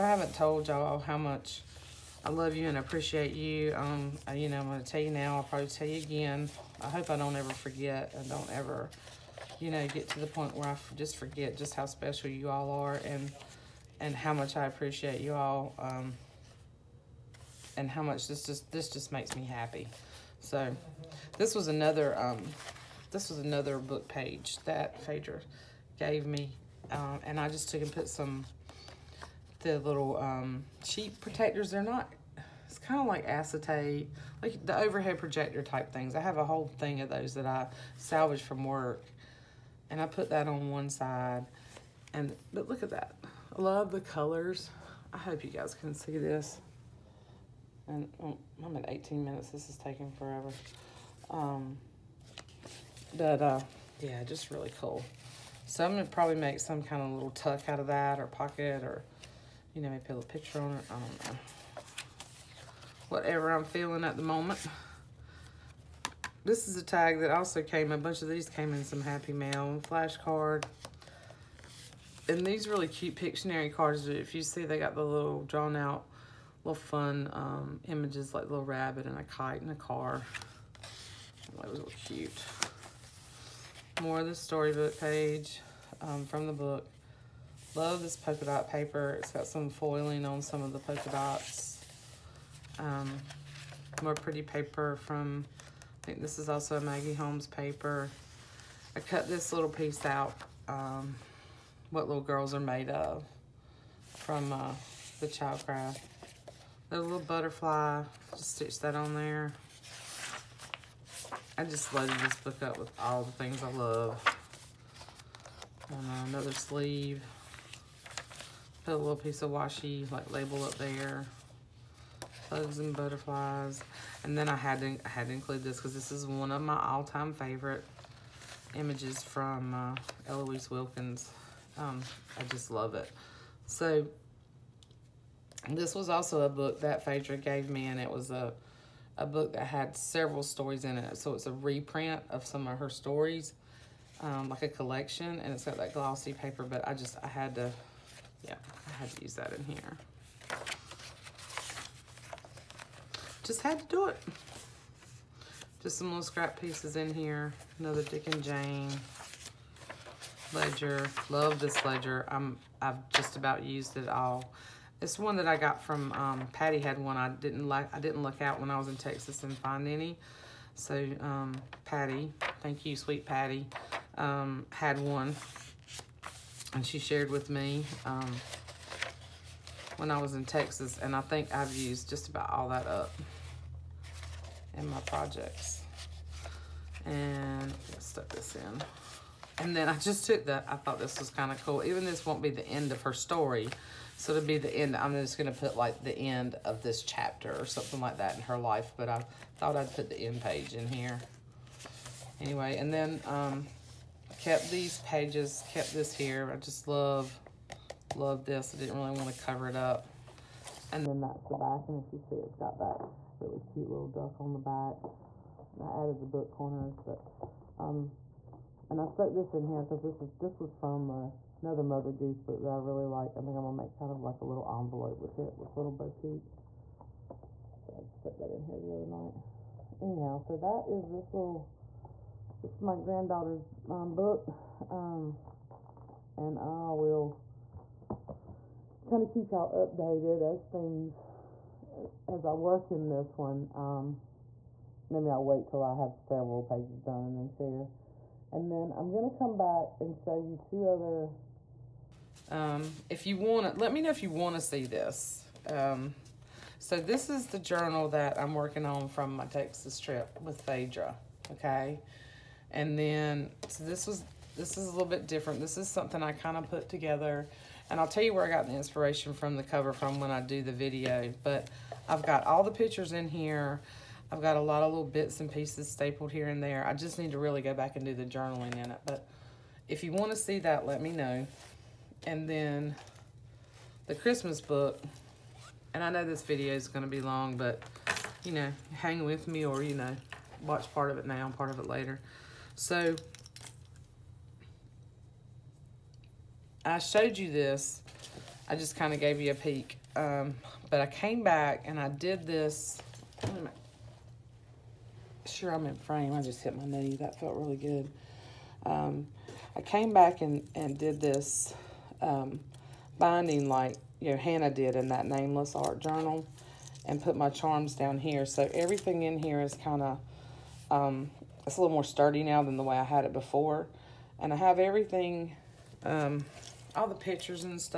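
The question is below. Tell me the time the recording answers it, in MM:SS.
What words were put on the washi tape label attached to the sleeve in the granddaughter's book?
02:02.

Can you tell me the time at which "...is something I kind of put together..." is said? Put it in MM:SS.
04:25.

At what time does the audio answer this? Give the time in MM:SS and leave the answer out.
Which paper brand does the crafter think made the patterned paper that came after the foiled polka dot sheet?
01:36.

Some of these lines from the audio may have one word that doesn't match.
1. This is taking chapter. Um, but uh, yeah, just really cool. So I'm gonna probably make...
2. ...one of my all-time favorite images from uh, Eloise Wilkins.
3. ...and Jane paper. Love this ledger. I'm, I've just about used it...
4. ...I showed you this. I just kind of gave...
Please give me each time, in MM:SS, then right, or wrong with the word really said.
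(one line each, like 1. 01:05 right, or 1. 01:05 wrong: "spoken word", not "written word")
1. 00:49 wrong: "forever", not "chapter"
2. 02:06 right
3. 02:38 wrong: "ledger", not "paper"
4. 04:56 right.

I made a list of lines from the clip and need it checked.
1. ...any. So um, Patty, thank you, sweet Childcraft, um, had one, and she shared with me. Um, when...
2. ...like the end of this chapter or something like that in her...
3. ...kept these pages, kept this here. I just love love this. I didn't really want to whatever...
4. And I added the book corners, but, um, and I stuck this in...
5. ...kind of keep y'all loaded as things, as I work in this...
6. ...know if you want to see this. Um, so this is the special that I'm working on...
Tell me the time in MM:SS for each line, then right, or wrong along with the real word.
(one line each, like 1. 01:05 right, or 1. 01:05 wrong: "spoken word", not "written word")
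1. 02:49 wrong: "Patty", not "Childcraft"
2. 03:15 right
3. 03:24 wrong: "cover", not "whatever"
4. 03:35 right
5. 03:59 wrong: "updated", not "loaded"
6. 04:14 wrong: "journal", not "special".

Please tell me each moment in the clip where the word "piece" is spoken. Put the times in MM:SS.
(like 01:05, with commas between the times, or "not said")
01:39, 01:59, 02:36, 04:35.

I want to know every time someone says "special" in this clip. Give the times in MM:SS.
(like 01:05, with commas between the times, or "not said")
00:11.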